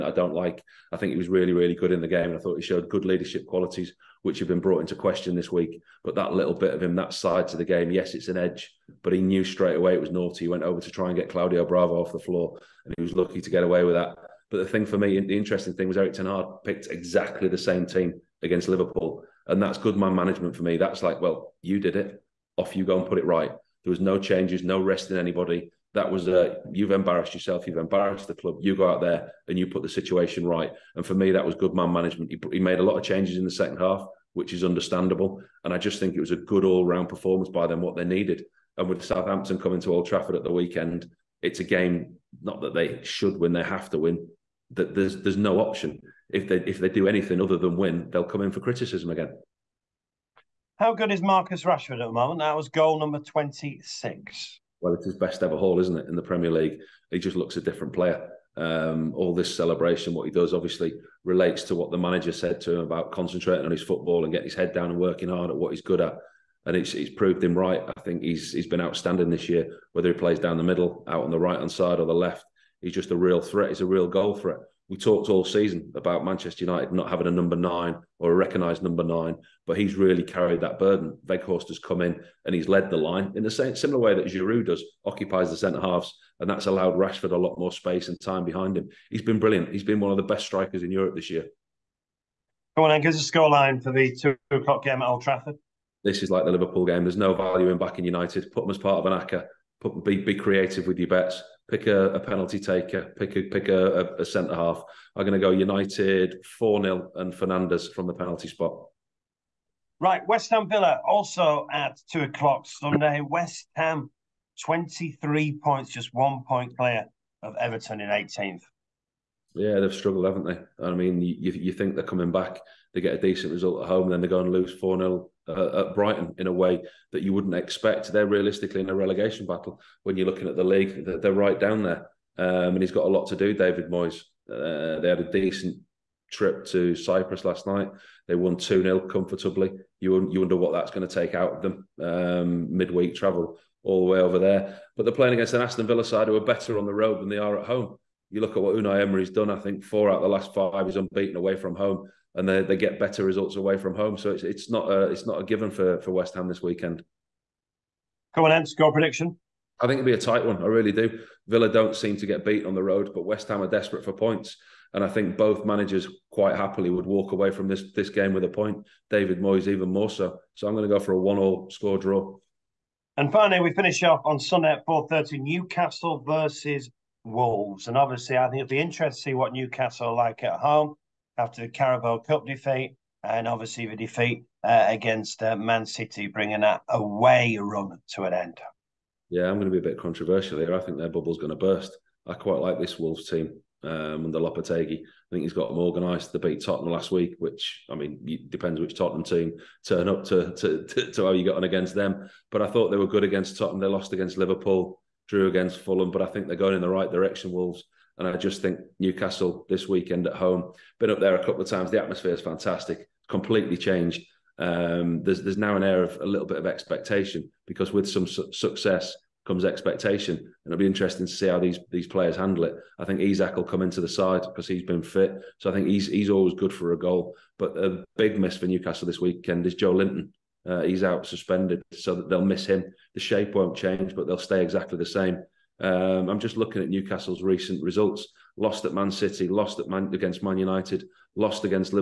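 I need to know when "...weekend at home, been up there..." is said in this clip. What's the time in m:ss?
3:29.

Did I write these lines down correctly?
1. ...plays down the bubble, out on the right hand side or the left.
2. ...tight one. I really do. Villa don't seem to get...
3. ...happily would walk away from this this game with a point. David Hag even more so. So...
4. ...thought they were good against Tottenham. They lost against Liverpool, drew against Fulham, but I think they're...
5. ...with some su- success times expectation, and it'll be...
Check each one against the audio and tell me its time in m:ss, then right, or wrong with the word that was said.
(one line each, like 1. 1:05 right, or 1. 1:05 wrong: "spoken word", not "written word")
1. 1:10 wrong: "middle", not "bubble"
2. 2:40 right
3. 2:46 wrong: "Moyes", not "Hag"
4. 3:22 right
5. 3:37 wrong: "comes", not "times".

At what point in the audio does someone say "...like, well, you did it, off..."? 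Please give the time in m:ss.
0:21.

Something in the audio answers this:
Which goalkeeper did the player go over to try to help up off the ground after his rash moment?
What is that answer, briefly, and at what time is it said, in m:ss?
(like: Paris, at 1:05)
Claudio Bravo, at 0:11.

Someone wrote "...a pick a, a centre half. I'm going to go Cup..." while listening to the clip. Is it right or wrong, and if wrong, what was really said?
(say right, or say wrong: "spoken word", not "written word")
wrong: "United", not "Cup".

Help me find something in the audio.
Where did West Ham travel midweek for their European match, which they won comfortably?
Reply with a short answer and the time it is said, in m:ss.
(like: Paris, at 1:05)
Cyprus, at 2:16.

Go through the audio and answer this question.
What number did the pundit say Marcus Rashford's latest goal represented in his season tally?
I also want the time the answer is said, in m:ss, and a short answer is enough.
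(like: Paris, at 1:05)
26, at 0:53.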